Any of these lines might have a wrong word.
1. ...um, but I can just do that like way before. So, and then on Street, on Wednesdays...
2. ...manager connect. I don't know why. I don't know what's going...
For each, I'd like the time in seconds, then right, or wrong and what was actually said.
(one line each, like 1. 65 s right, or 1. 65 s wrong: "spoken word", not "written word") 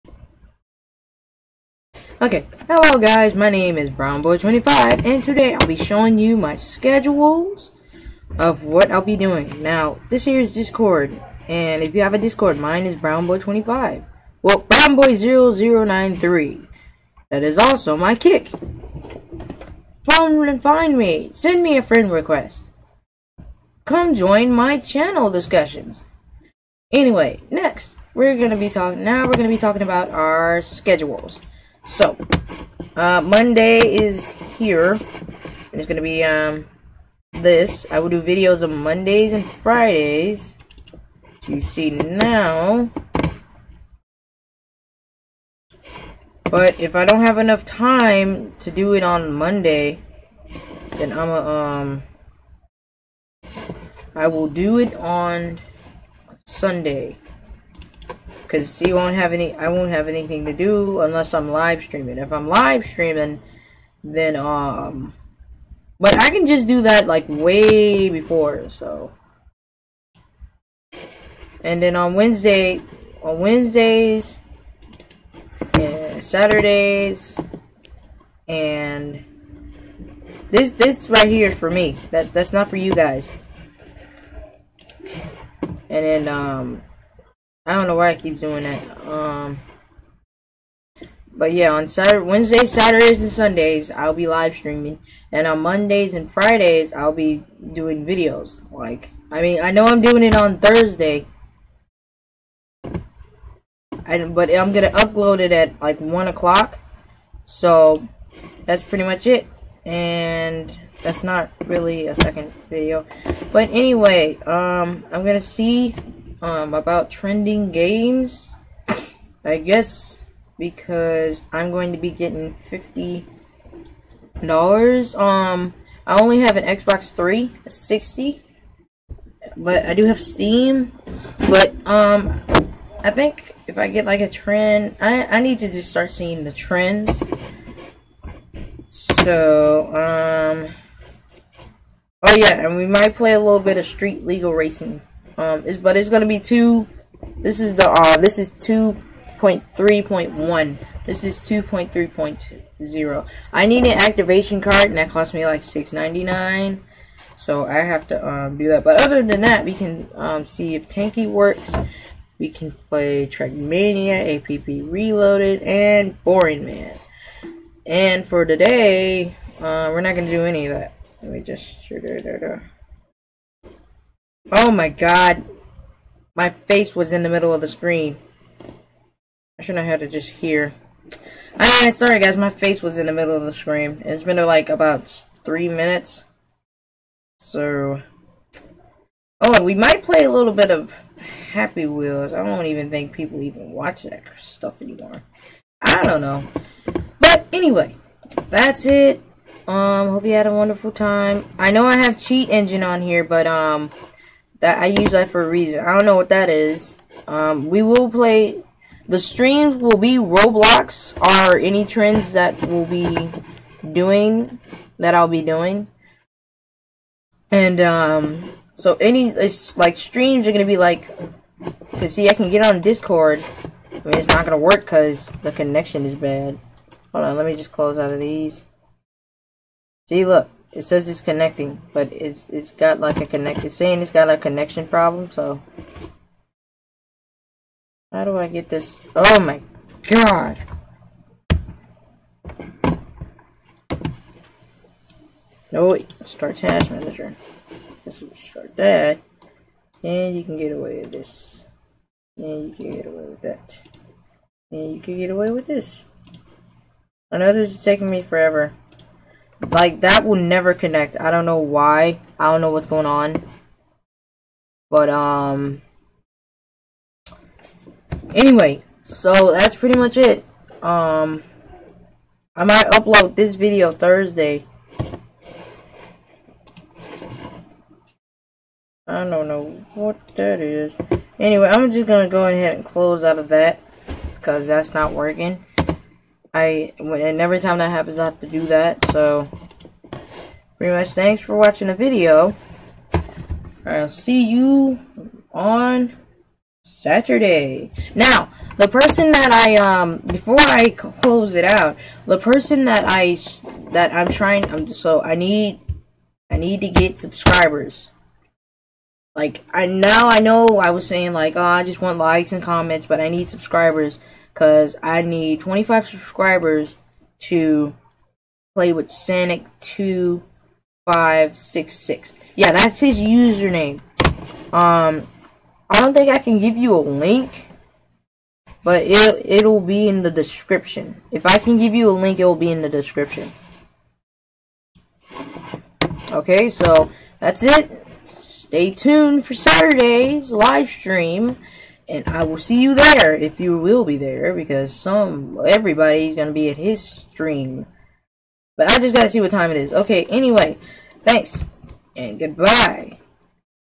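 1. 64 s wrong: "Wednesday", not "Street"
2. 260 s wrong: "never", not "manager".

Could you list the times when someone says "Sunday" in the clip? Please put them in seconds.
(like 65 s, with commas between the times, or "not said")
56 s, 93 s.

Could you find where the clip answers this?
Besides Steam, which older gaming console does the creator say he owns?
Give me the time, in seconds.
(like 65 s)
126 s.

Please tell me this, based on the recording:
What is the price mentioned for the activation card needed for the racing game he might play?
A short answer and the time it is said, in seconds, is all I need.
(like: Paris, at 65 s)
6.99, at 155 s.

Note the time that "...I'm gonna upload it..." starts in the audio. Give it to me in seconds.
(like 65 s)
104 s.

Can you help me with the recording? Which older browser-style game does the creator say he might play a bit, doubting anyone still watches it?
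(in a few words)
Happy Wheels.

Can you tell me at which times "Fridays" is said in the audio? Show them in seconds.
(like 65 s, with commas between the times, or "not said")
39 s, 96 s.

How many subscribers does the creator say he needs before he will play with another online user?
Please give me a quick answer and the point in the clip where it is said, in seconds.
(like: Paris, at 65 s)
25, at 315 s.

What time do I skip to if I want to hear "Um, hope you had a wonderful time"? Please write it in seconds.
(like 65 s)
199 s.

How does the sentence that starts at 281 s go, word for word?
Anyway, I'm just going to go ahead and close out of that.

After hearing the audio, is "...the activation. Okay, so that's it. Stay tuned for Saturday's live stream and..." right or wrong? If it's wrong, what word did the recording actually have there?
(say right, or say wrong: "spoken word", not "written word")
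wrong: "description", not "activation".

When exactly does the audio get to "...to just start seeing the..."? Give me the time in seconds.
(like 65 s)
135 s.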